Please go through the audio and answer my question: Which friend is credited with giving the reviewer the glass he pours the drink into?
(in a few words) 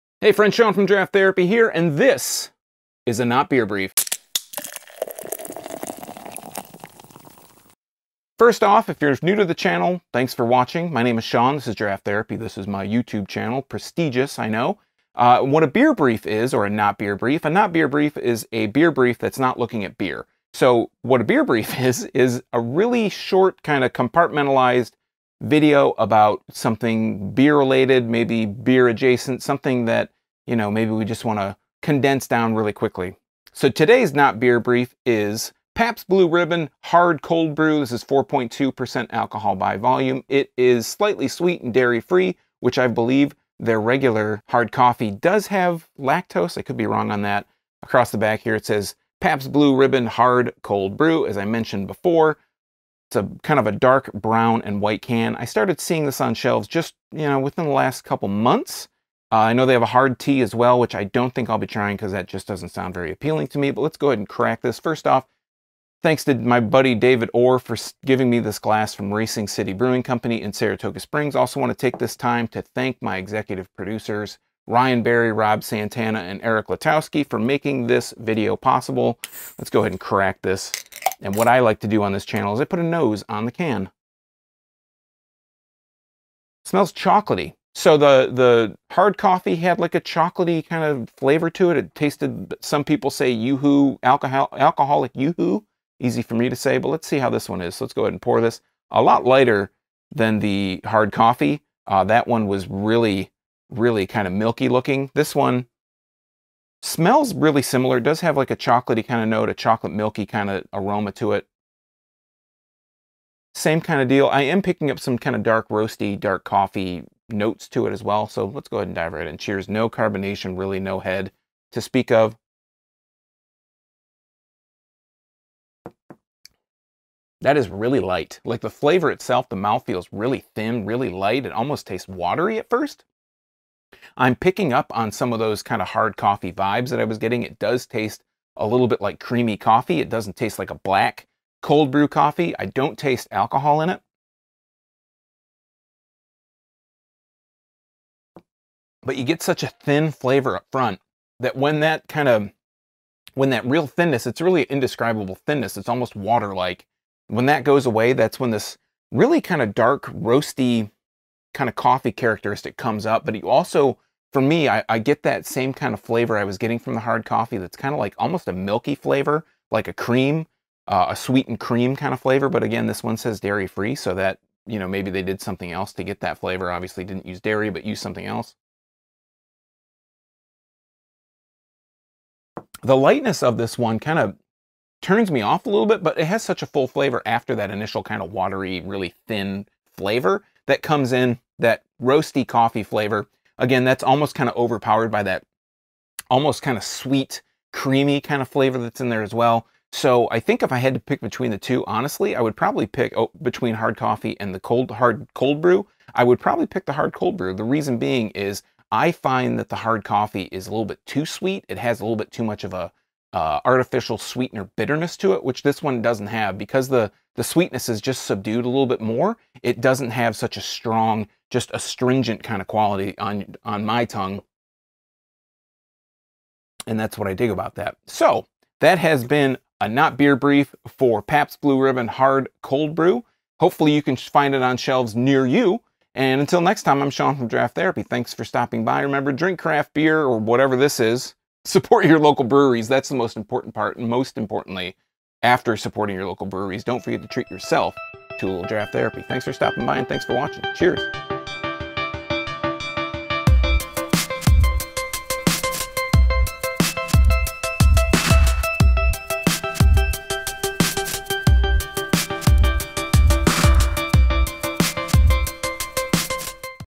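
David Orr.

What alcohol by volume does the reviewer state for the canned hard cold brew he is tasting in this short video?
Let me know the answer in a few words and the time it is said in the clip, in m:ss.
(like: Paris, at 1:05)
4.2%, at 0:38.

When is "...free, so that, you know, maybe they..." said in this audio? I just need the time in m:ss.
2:53.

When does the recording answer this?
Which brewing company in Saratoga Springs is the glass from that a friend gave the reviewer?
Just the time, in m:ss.
1:09.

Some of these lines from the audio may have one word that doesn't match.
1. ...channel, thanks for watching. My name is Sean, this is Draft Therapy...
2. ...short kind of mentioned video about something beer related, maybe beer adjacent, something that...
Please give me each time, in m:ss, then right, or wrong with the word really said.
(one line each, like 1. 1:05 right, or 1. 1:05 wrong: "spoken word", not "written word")
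1. 0:09 right
2. 0:23 wrong: "compartmentalized", not "mentioned".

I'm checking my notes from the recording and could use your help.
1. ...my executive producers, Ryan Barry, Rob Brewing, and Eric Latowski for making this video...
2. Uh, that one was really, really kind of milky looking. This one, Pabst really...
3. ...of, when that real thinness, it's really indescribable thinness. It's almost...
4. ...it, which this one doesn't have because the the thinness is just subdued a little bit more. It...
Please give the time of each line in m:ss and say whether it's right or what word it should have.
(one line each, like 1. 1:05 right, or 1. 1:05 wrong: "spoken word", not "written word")
1. 1:13 wrong: "Santana", not "Brewing"
2. 1:41 wrong: "Smells", not "Pabst"
3. 2:32 right
4. 3:35 wrong: "sweetness", not "thinness".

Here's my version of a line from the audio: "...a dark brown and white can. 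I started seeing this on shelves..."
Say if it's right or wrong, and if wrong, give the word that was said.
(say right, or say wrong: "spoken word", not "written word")
right.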